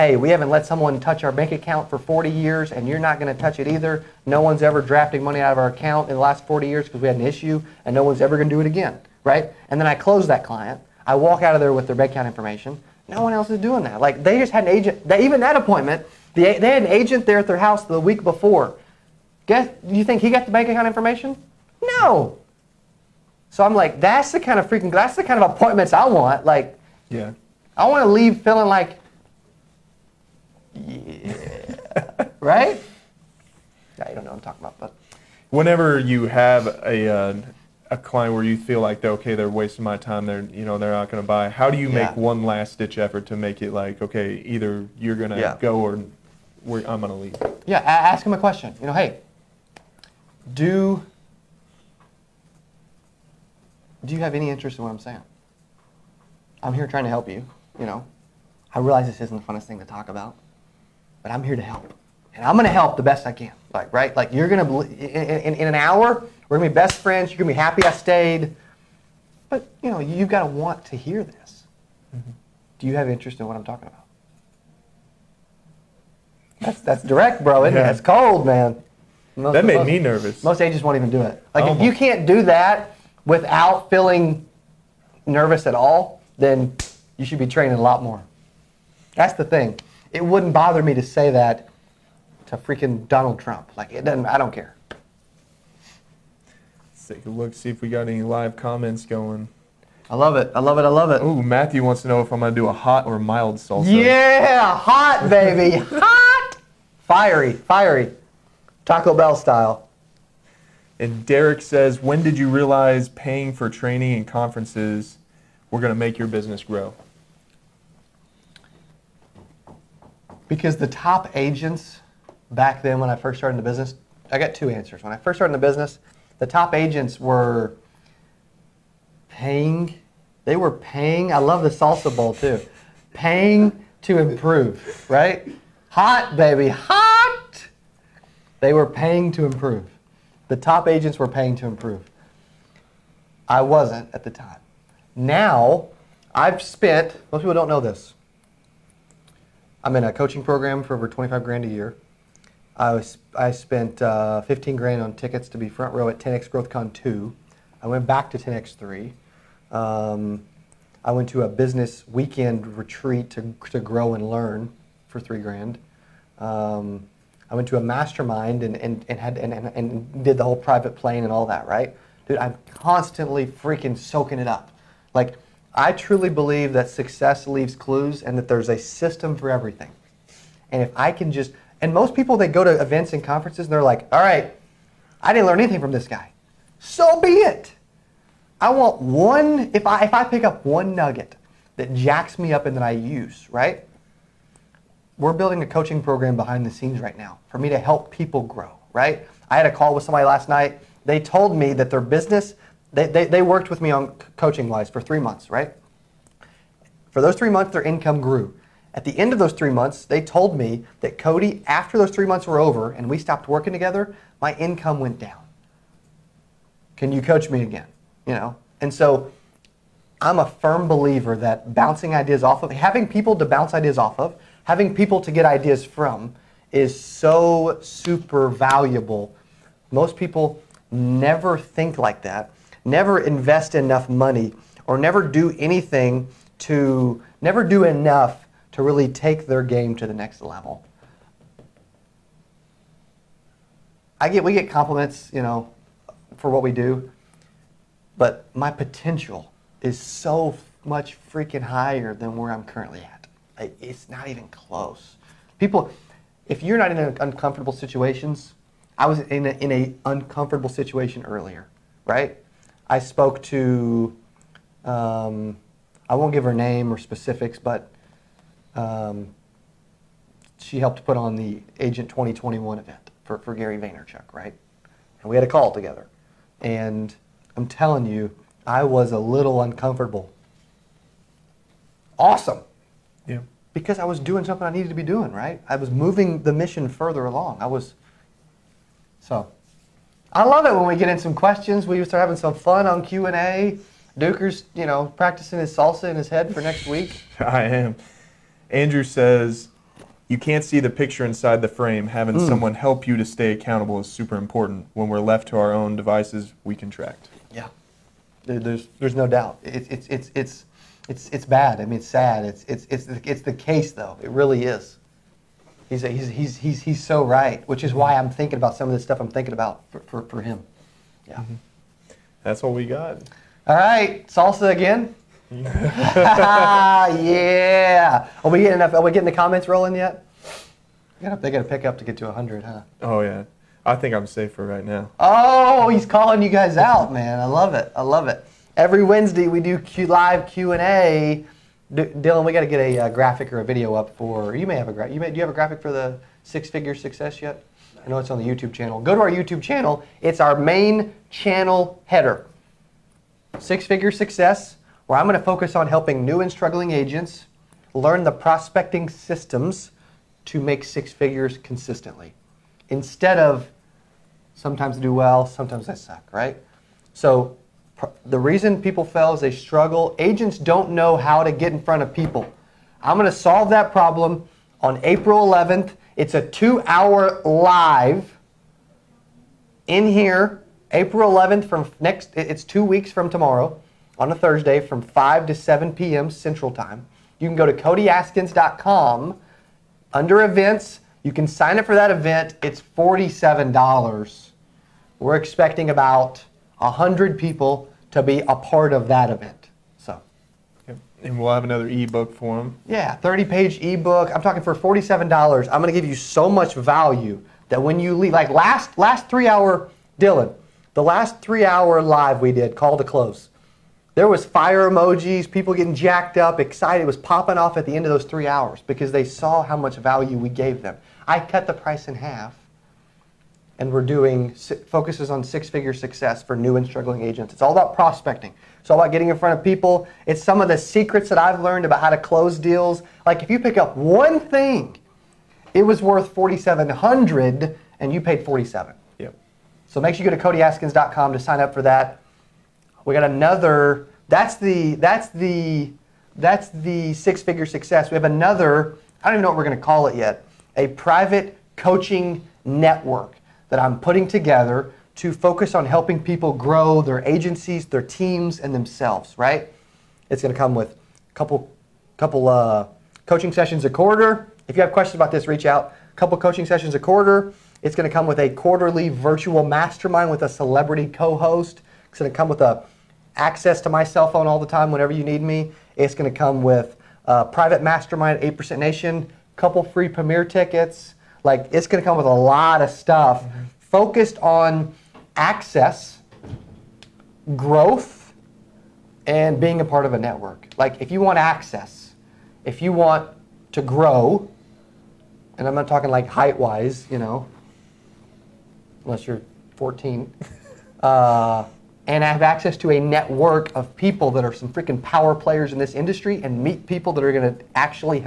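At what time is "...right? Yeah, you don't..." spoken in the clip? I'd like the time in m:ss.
0:32.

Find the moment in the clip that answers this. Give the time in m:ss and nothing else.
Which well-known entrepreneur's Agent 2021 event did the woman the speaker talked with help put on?
4:33.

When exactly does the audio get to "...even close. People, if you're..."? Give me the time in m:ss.
4:14.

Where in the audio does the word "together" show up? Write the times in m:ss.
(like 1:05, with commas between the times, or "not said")
3:33, 4:35, 7:34.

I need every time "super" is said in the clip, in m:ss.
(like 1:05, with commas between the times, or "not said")
3:47, 5:04.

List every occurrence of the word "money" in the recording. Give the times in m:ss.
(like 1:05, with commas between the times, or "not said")
0:05, 3:54.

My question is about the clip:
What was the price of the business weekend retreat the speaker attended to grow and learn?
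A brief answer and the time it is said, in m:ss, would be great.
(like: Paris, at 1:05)
3 grand, at 2:45.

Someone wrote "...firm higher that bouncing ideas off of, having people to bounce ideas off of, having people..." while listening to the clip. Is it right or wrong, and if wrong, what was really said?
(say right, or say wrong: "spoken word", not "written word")
wrong: "believer", not "higher".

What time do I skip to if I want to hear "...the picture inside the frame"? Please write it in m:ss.
5:00.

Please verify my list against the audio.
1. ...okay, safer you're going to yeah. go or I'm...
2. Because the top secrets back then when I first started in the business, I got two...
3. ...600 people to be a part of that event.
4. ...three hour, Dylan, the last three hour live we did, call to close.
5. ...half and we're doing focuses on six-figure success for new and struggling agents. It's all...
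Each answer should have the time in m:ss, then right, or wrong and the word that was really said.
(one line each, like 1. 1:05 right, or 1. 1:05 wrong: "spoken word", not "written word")
1. 0:44 wrong: "either", not "safer"
2. 2:00 wrong: "agents", not "secrets"
3. 6:36 wrong: "100", not "600"
4. 6:49 right
5. 7:02 right.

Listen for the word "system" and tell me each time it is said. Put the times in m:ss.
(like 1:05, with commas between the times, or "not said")
2:58, 5:59.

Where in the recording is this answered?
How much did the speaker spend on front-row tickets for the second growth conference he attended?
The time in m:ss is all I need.
2:34.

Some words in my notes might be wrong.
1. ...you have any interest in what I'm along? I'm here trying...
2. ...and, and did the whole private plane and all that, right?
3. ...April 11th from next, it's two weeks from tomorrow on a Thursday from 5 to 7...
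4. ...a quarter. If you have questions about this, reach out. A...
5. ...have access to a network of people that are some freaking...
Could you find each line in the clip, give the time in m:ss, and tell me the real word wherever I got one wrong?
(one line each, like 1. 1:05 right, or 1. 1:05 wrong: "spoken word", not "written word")
1. 0:54 wrong: "saying", not "along"
2. 2:49 right
3. 6:20 right
4. 7:43 right
5. 8:22 right.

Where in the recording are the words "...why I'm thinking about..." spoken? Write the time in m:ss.
5:17.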